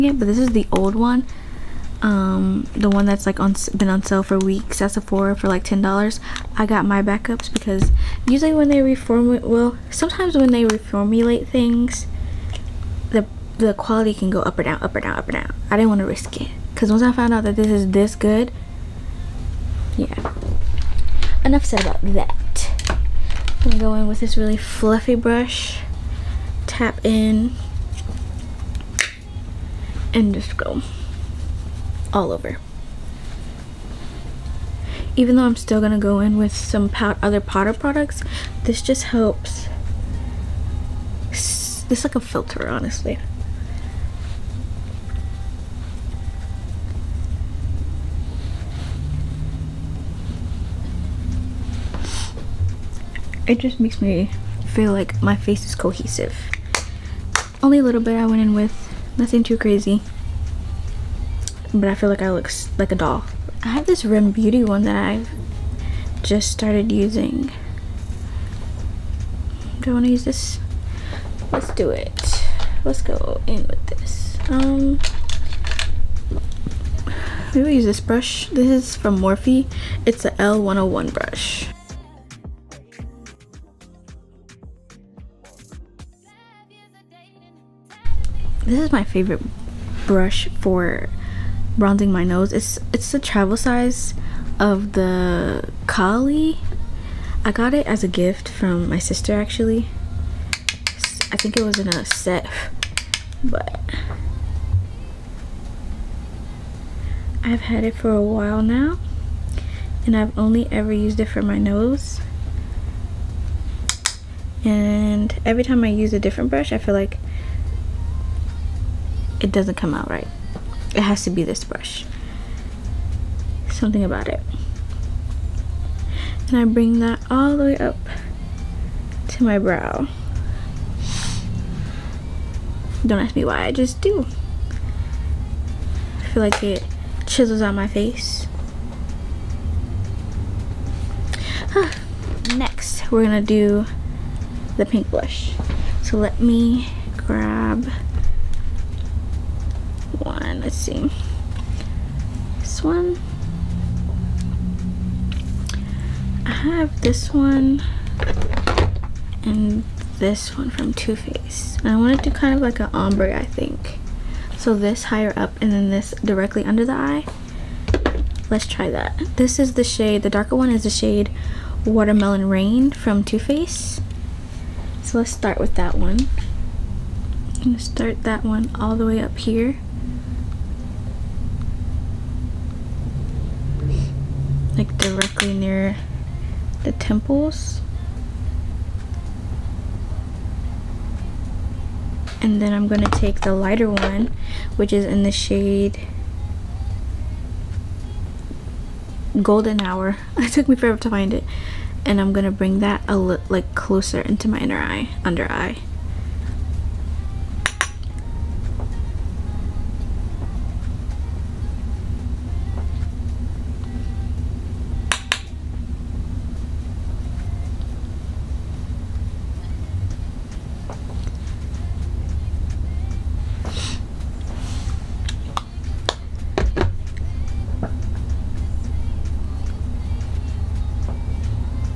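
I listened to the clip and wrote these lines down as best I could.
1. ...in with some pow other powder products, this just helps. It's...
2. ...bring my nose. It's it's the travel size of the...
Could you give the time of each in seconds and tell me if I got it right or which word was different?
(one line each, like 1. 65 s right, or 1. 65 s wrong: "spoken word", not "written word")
1. 36 s right
2. 91 s wrong: "bronzing", not "bring".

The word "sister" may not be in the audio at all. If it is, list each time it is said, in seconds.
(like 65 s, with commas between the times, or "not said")
98 s.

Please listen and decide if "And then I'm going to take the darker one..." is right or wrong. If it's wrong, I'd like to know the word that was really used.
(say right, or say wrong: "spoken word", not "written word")
wrong: "lighter", not "darker".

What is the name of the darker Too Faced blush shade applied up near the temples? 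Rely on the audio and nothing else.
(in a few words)
Watermelon Rain.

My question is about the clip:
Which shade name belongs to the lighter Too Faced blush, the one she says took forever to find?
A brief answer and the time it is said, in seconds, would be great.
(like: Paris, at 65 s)
Golden Hour, at 199 s.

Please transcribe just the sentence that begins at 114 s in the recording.
And every time I use a different brush, I feel like it doesn't come out right.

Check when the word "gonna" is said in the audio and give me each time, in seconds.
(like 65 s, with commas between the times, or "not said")
143 s, 177 s.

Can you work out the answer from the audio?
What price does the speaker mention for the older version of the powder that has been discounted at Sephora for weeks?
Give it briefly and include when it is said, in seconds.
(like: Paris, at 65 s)
$10, at 5 s.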